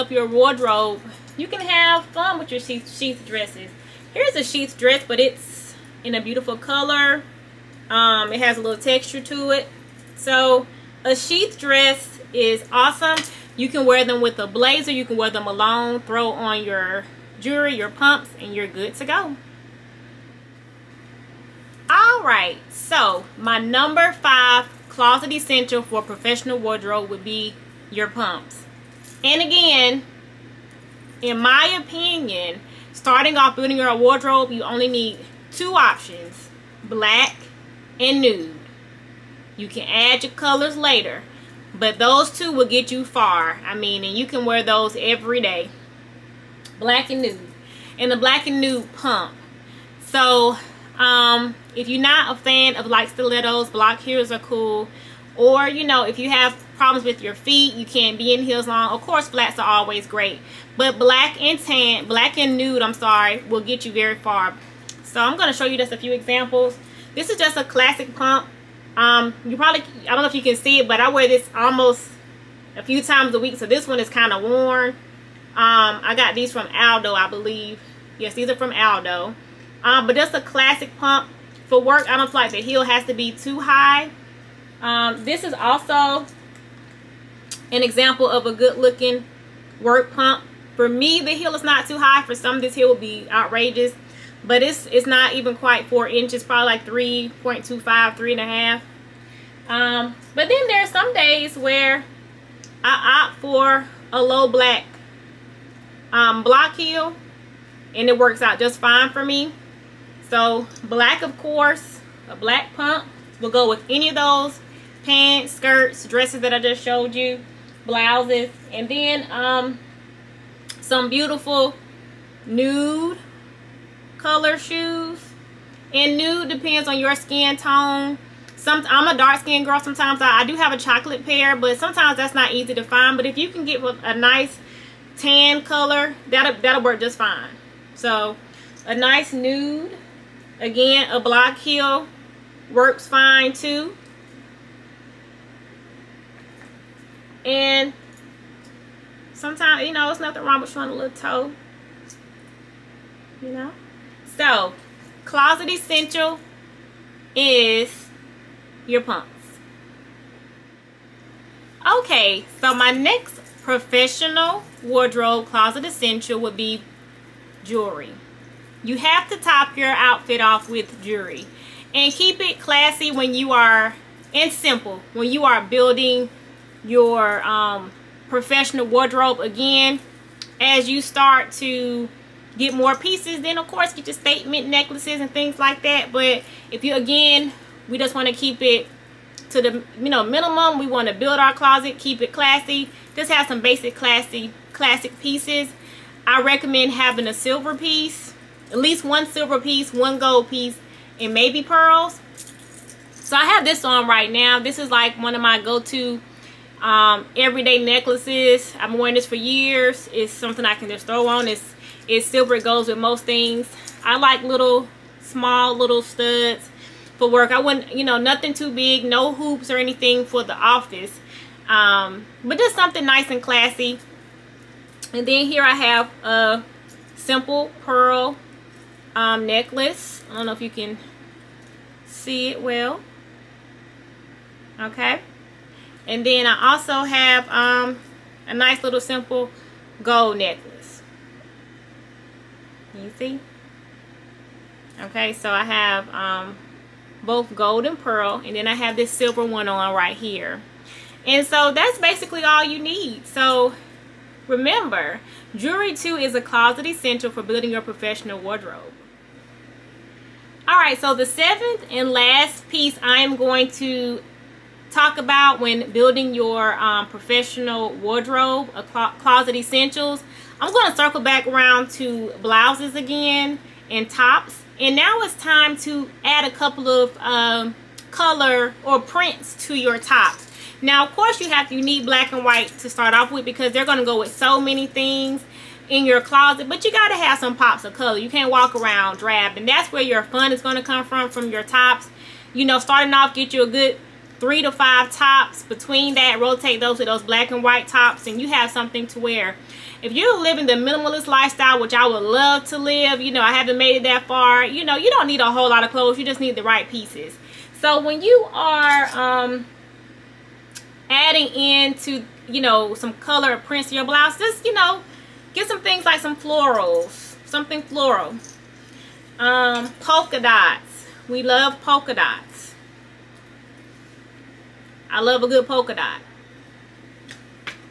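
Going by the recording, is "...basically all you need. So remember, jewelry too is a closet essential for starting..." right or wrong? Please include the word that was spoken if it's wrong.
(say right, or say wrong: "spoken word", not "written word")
wrong: "building", not "starting".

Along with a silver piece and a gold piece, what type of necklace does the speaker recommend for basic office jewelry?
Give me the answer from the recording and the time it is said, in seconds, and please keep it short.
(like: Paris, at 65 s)
pearls, at 201 s.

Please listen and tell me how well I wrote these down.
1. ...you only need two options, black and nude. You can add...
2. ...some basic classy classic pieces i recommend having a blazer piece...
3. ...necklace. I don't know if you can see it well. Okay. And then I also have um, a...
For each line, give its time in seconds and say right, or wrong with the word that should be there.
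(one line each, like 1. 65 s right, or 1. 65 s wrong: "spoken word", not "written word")
1. 34 s right
2. 193 s wrong: "silver", not "blazer"
3. 229 s right.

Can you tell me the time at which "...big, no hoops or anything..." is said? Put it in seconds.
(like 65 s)
218 s.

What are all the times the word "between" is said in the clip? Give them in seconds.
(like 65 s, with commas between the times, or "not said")
295 s.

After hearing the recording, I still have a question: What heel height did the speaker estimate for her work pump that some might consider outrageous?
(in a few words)
3.25 inches.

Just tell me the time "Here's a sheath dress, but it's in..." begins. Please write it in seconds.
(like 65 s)
4 s.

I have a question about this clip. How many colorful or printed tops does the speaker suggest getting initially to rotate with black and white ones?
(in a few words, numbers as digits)
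3 to 5.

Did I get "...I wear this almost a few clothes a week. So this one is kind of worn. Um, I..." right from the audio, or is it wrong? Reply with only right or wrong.
wrong.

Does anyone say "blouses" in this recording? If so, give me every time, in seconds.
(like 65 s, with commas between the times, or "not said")
117 s, 272 s, 314 s.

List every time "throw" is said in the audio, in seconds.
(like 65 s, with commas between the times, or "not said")
16 s, 211 s.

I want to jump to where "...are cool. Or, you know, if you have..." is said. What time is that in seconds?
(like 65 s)
54 s.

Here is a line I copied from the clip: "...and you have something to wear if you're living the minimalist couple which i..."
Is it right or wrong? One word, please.
wrong.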